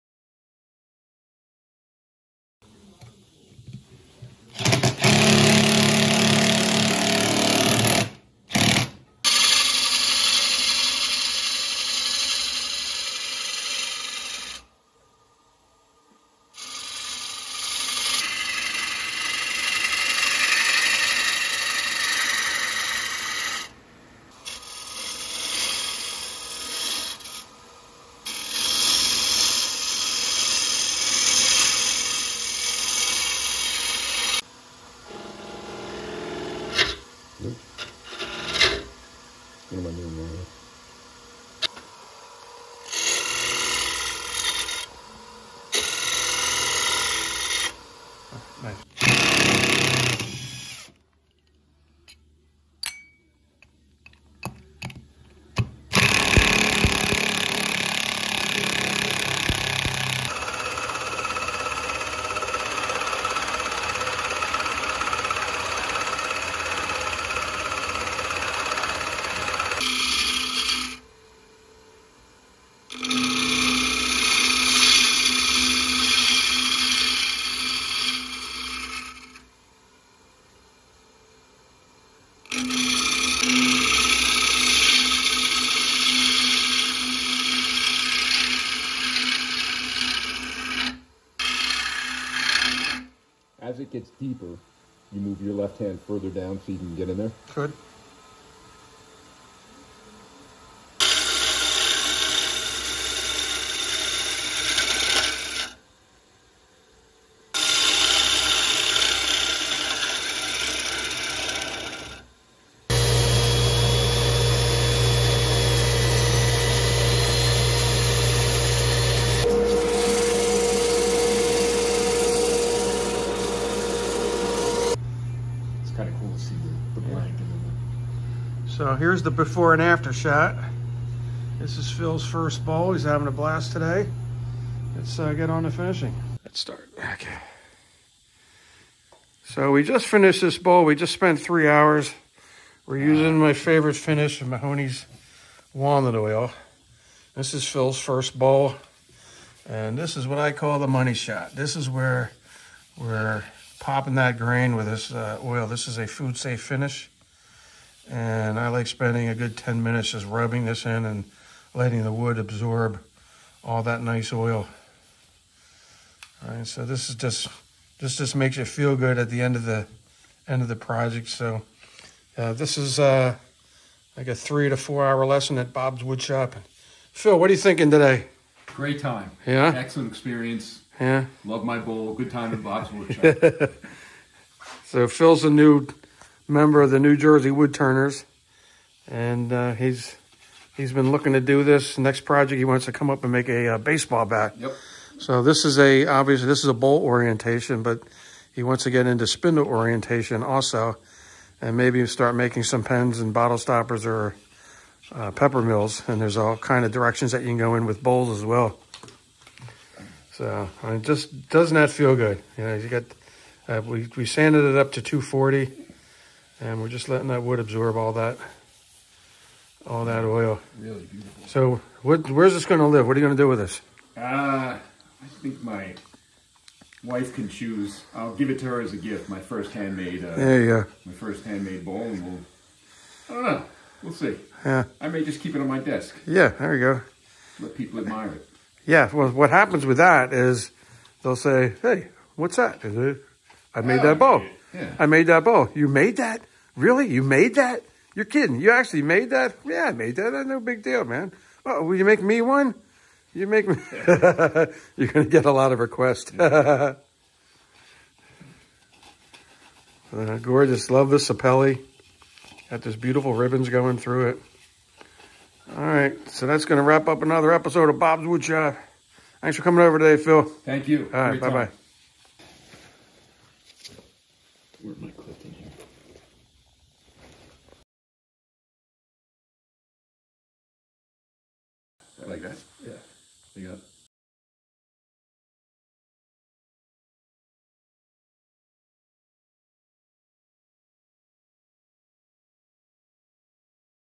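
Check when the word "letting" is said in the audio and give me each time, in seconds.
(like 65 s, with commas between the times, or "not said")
161 s, 217 s.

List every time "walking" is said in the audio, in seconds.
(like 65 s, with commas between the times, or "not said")
not said.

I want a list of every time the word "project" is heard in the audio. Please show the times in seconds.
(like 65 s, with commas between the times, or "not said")
170 s, 192 s.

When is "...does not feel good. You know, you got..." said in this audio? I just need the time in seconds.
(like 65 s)
211 s.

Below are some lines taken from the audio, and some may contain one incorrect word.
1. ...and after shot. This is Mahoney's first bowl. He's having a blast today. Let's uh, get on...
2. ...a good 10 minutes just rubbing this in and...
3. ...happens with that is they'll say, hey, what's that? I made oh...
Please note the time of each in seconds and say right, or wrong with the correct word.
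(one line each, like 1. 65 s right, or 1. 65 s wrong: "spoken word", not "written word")
1. 129 s wrong: "Phil", not "Mahoney"
2. 159 s right
3. 239 s right.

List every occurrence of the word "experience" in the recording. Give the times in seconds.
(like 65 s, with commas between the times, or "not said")
180 s.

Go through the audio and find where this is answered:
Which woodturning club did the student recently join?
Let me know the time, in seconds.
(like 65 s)
186 s.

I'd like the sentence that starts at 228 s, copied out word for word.
I'll give it to her as a gift, my first handmade.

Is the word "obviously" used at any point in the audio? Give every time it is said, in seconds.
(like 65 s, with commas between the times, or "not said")
196 s.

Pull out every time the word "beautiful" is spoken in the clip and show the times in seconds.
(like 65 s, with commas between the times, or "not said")
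221 s, 262 s.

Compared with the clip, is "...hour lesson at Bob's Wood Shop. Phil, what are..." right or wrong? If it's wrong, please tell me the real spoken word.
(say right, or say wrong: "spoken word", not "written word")
right.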